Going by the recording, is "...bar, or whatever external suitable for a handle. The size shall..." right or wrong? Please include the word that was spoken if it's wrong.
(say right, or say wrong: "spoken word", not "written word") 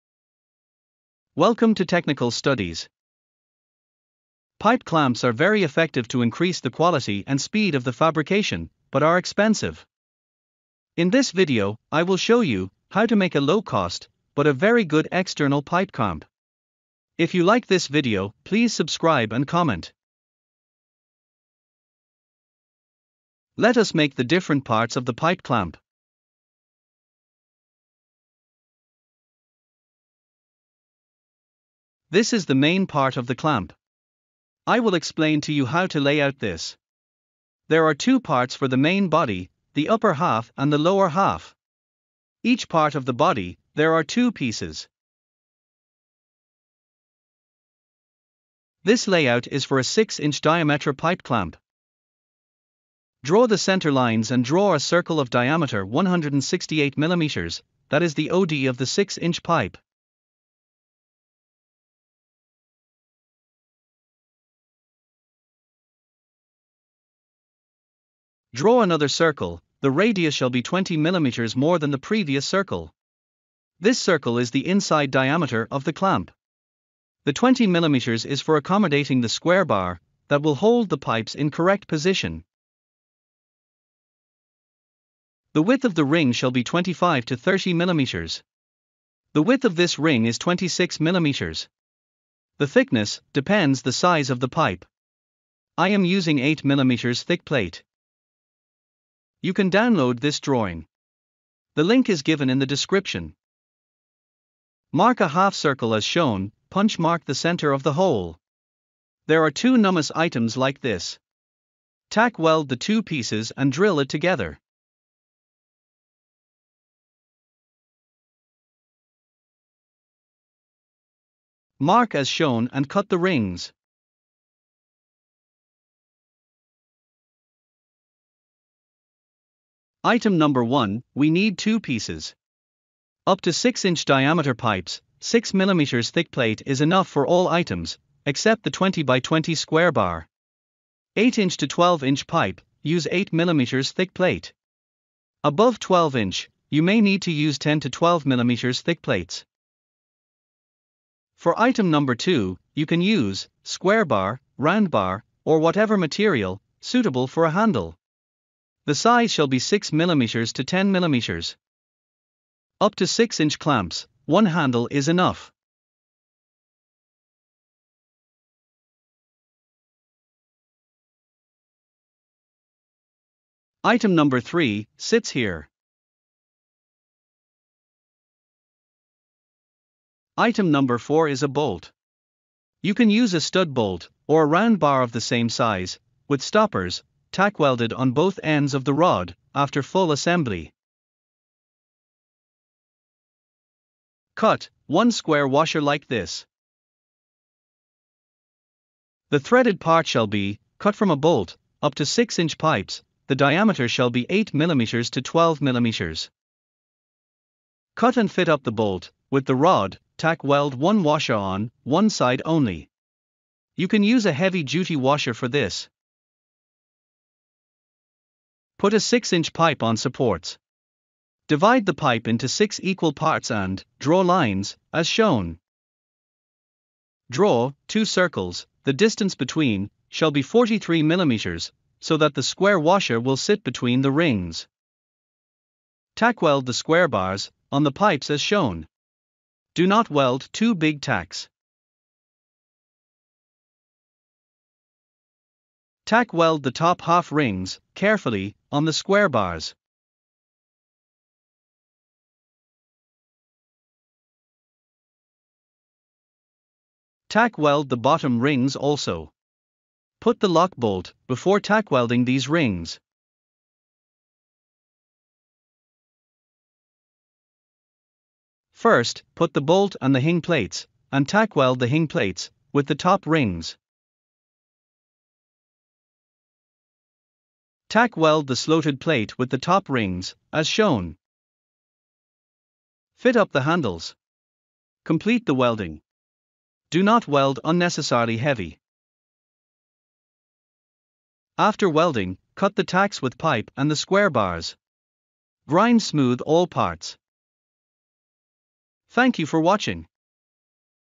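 wrong: "material", not "external".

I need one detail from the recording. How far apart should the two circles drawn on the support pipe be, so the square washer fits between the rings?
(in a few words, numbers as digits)
43 mm.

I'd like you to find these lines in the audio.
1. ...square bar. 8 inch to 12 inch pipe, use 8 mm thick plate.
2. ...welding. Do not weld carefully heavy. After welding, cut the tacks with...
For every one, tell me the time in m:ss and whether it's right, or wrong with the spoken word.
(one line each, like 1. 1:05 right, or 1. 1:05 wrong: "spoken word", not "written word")
1. 2:19 right
2. 4:45 wrong: "unnecessarily", not "carefully".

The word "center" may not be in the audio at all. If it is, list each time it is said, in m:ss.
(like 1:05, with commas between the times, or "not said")
0:53, 1:47.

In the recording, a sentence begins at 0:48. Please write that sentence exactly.
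This layout is for a 6-inch diameter pipe clamp.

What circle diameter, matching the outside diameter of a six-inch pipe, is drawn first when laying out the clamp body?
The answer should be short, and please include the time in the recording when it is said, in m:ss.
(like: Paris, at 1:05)
168 mm, at 0:55.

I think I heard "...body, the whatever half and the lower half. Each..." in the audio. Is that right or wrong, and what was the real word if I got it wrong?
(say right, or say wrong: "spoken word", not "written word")
wrong: "upper", not "whatever".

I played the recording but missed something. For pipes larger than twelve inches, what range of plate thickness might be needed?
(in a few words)
10 to 12 mm.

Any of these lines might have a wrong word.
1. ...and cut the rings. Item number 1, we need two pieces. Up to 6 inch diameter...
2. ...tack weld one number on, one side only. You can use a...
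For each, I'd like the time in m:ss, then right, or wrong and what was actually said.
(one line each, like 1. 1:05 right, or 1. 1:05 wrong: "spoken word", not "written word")
1. 2:02 right
2. 3:30 wrong: "washer", not "number".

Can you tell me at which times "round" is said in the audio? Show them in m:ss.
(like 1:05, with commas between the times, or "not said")
2:34, 3:04.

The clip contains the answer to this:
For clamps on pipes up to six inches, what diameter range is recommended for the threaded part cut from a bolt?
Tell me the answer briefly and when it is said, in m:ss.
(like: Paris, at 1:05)
8 to 12 mm, at 3:24.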